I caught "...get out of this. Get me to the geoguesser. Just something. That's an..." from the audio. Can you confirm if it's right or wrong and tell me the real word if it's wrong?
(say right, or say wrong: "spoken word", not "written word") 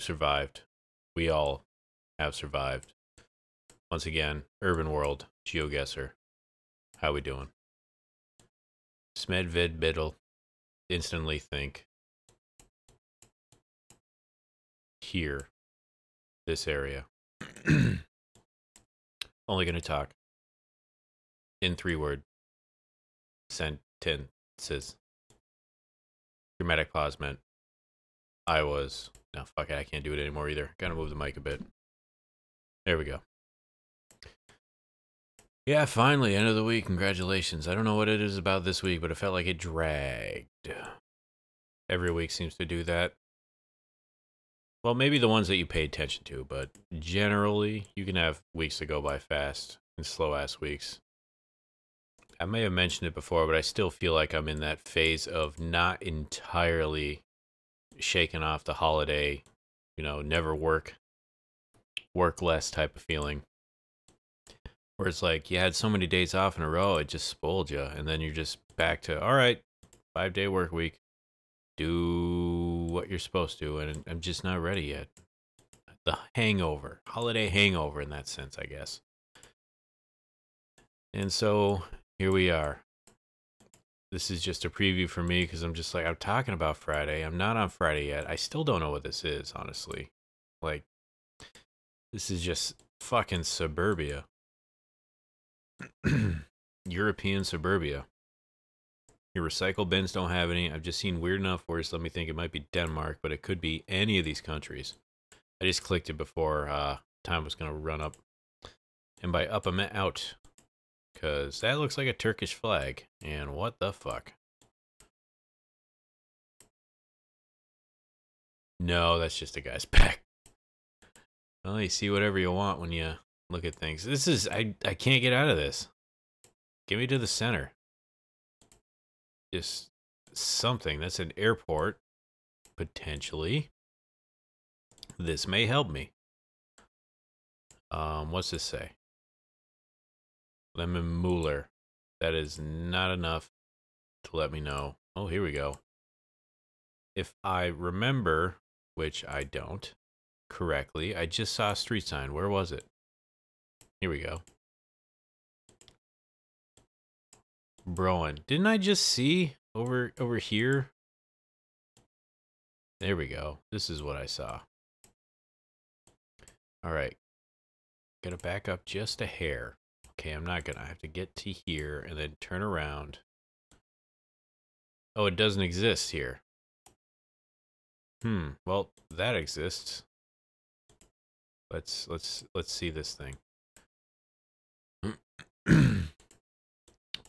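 wrong: "center", not "geoguesser".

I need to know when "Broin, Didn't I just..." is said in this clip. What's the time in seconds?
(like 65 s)
157 s.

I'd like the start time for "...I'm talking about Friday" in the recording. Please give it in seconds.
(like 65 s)
86 s.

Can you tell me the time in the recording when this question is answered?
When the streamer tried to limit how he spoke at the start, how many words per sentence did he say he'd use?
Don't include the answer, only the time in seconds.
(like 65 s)
21 s.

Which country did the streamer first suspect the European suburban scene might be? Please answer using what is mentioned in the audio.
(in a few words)
Denmark.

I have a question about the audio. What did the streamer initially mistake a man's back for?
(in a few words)
A Turkish flag.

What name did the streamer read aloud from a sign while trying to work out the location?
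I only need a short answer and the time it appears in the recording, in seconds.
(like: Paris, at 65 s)
Lemon Mueller, at 140 s.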